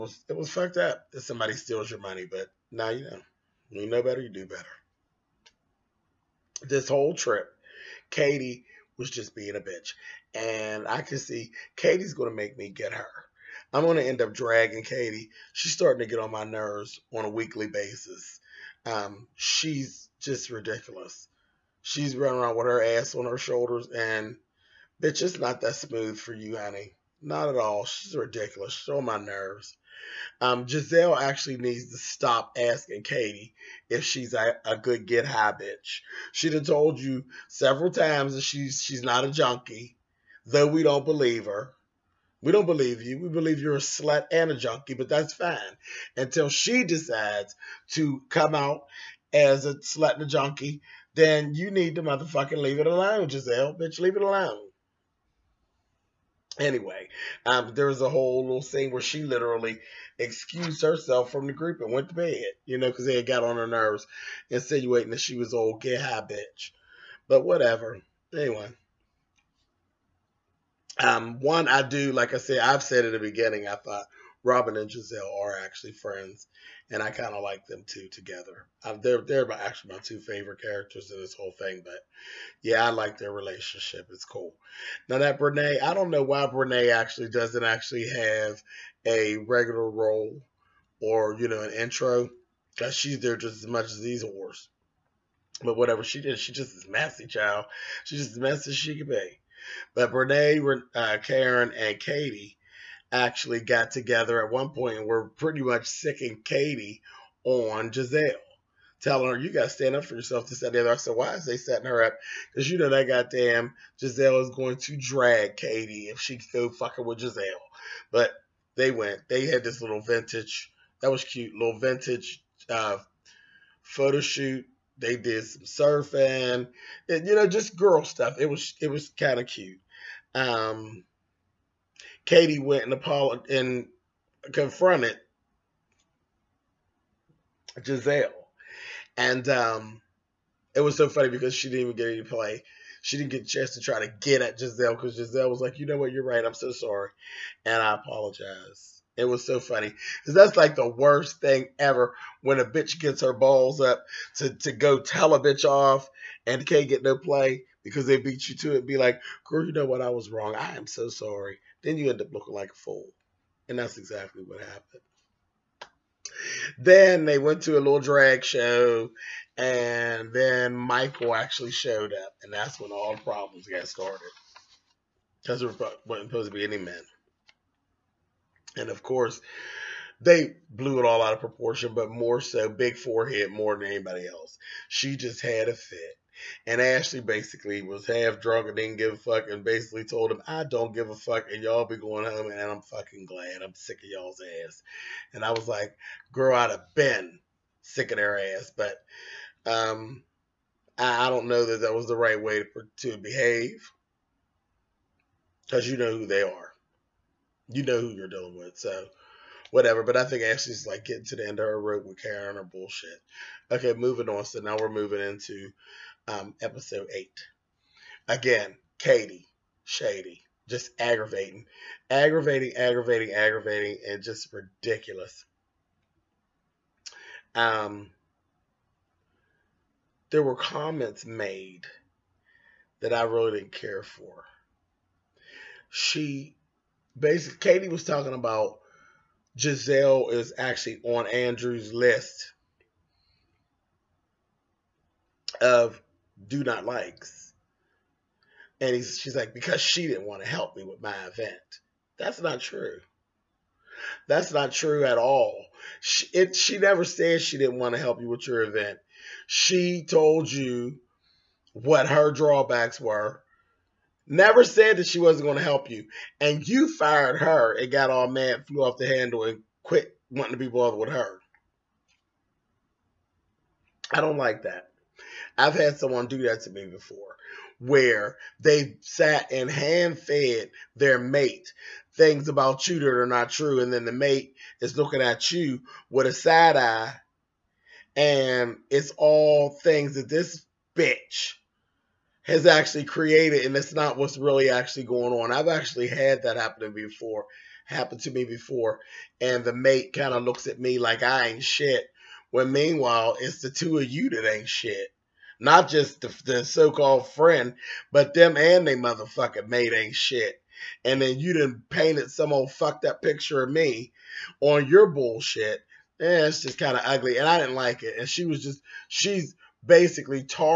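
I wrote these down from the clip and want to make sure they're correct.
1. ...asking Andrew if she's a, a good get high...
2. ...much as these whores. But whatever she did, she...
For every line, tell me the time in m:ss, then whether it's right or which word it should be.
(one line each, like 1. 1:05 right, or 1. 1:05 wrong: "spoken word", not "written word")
1. 0:32 wrong: "Katie", not "Andrew"
2. 1:33 right.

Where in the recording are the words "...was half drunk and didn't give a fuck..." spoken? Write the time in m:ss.
3:07.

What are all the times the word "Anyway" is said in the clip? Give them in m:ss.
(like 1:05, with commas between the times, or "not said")
0:56, 1:08.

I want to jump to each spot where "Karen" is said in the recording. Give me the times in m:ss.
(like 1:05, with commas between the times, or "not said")
1:41, 3:32.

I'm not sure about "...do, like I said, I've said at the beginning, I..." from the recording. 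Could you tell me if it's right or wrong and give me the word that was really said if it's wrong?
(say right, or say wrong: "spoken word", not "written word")
right.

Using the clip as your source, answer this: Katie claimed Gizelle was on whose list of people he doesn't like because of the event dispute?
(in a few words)
Andrew.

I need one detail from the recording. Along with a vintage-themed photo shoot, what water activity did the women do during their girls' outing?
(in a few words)
Surfing.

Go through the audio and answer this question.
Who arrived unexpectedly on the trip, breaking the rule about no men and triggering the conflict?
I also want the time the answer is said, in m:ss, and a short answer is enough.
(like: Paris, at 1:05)
Michael, at 2:50.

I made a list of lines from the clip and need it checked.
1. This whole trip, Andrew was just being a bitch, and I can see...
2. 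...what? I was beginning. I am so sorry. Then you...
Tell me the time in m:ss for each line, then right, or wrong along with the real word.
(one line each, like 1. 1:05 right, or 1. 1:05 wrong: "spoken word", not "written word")
1. 0:06 wrong: "Katie", not "Andrew"
2. 2:39 wrong: "wrong", not "beginning".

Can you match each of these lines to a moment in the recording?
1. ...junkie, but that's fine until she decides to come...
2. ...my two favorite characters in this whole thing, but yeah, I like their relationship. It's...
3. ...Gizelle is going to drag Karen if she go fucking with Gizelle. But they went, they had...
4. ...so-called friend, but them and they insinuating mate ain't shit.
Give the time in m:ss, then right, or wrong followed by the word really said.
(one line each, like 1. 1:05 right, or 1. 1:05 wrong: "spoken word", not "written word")
1. 0:44 right
2. 1:19 right
3. 1:53 wrong: "Katie", not "Karen"
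4. 5:06 wrong: "motherfucking", not "insinuating".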